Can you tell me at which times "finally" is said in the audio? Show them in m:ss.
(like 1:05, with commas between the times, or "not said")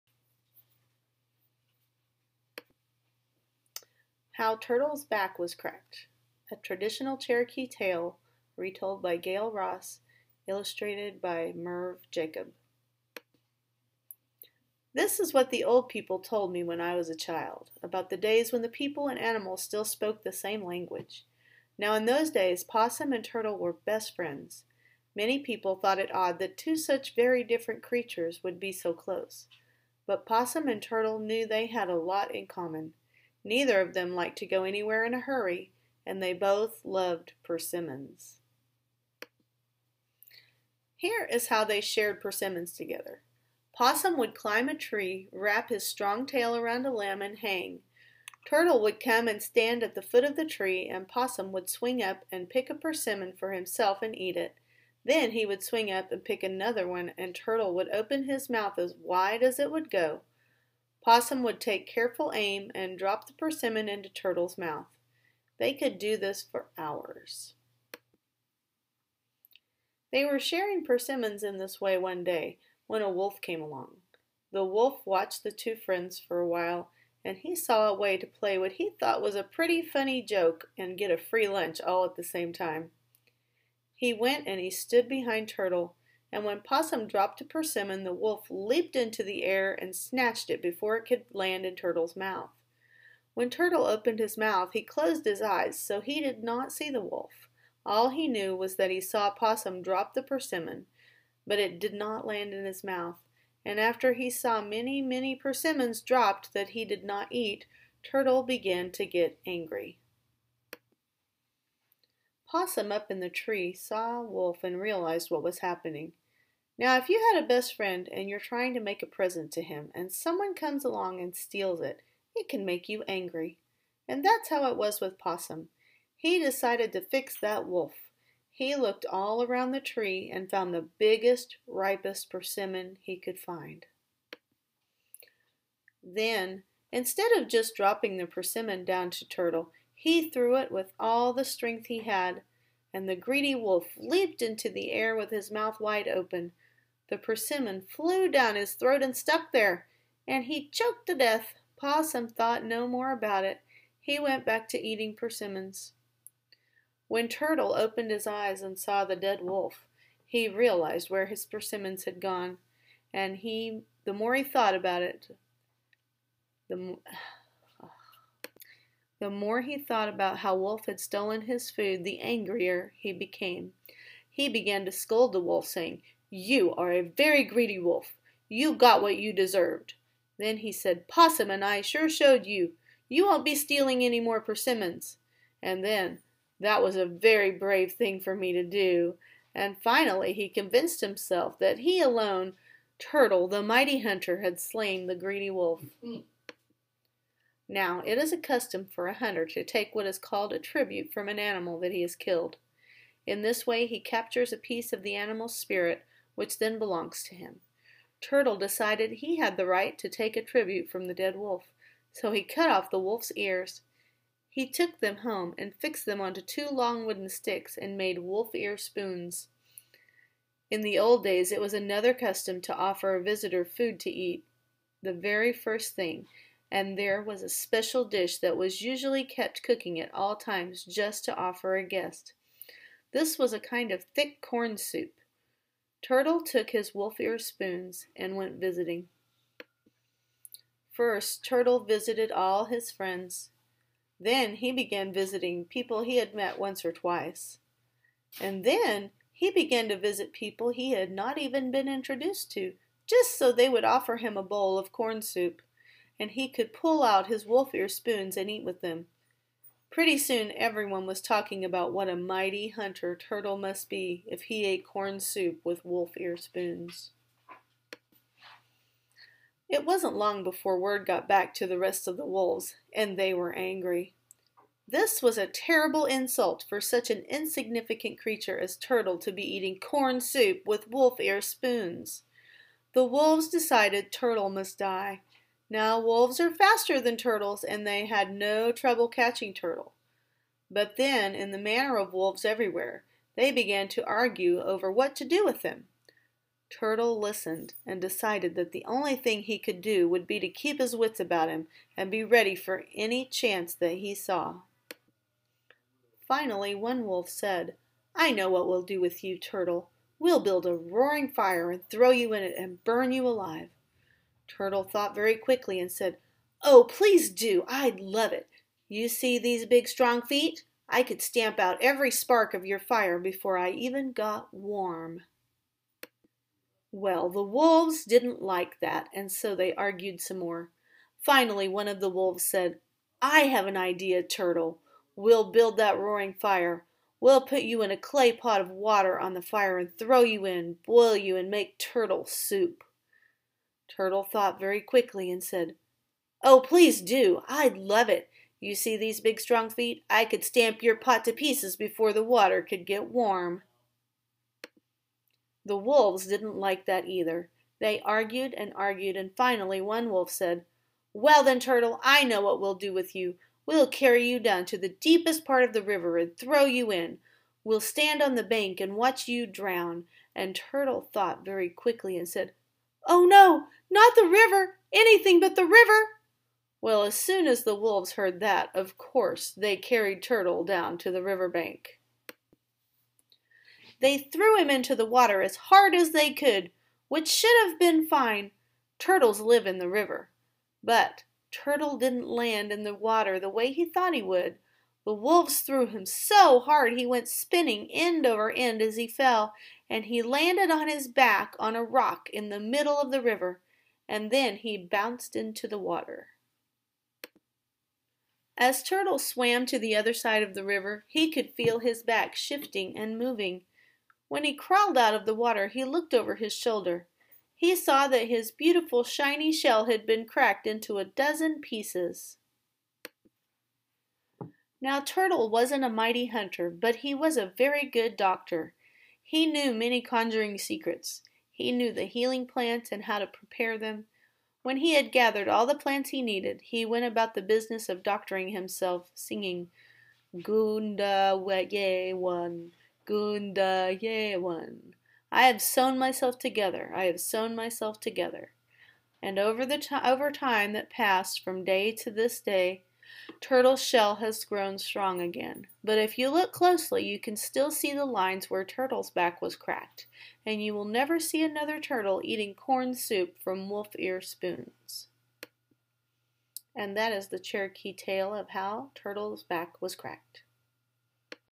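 3:09, 5:06, 5:31, 5:59.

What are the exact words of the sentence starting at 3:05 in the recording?
And then, that was a very brave thing for me to do.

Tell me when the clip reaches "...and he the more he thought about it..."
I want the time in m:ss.
2:43.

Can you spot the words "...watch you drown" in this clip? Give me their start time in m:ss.
6:08.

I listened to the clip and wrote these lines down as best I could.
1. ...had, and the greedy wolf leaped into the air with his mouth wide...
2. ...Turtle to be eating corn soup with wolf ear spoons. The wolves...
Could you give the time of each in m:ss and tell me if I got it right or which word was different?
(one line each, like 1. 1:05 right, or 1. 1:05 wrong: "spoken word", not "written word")
1. 2:21 right
2. 4:38 right.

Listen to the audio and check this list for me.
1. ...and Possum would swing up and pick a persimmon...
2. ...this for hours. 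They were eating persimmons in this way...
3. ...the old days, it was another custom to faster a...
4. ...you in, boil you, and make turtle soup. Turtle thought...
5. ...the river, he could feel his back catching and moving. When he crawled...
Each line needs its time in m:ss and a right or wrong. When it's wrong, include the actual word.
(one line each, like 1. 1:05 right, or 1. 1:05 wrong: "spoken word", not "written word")
1. 0:50 right
2. 1:06 wrong: "sharing", not "eating"
3. 3:40 wrong: "offer", not "faster"
4. 5:40 right
5. 6:50 wrong: "shifting", not "catching".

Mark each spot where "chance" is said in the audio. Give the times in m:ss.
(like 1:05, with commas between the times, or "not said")
5:03.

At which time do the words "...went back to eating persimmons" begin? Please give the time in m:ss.
2:34.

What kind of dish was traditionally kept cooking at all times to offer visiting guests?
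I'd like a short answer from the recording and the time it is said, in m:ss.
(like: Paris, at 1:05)
Thick corn soup, at 3:54.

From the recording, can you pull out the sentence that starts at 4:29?
It wasn't long before word got back to the rest of the wolves, and they were angry.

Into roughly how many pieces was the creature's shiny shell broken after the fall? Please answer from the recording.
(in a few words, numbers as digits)
12.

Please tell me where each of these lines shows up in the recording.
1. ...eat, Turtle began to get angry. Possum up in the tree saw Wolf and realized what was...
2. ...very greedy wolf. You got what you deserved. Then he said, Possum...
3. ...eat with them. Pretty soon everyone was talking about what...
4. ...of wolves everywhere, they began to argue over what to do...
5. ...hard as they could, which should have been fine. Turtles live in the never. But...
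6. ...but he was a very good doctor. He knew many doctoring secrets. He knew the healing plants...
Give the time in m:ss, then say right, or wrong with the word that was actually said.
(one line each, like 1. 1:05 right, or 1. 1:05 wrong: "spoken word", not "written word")
1. 1:47 right
2. 2:57 right
3. 4:18 right
4. 4:51 right
5. 6:25 wrong: "river", not "never"
6. 7:06 wrong: "conjuring", not "doctoring".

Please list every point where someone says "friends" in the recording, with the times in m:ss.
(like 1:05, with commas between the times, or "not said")
0:24, 1:15, 1:57, 4:02.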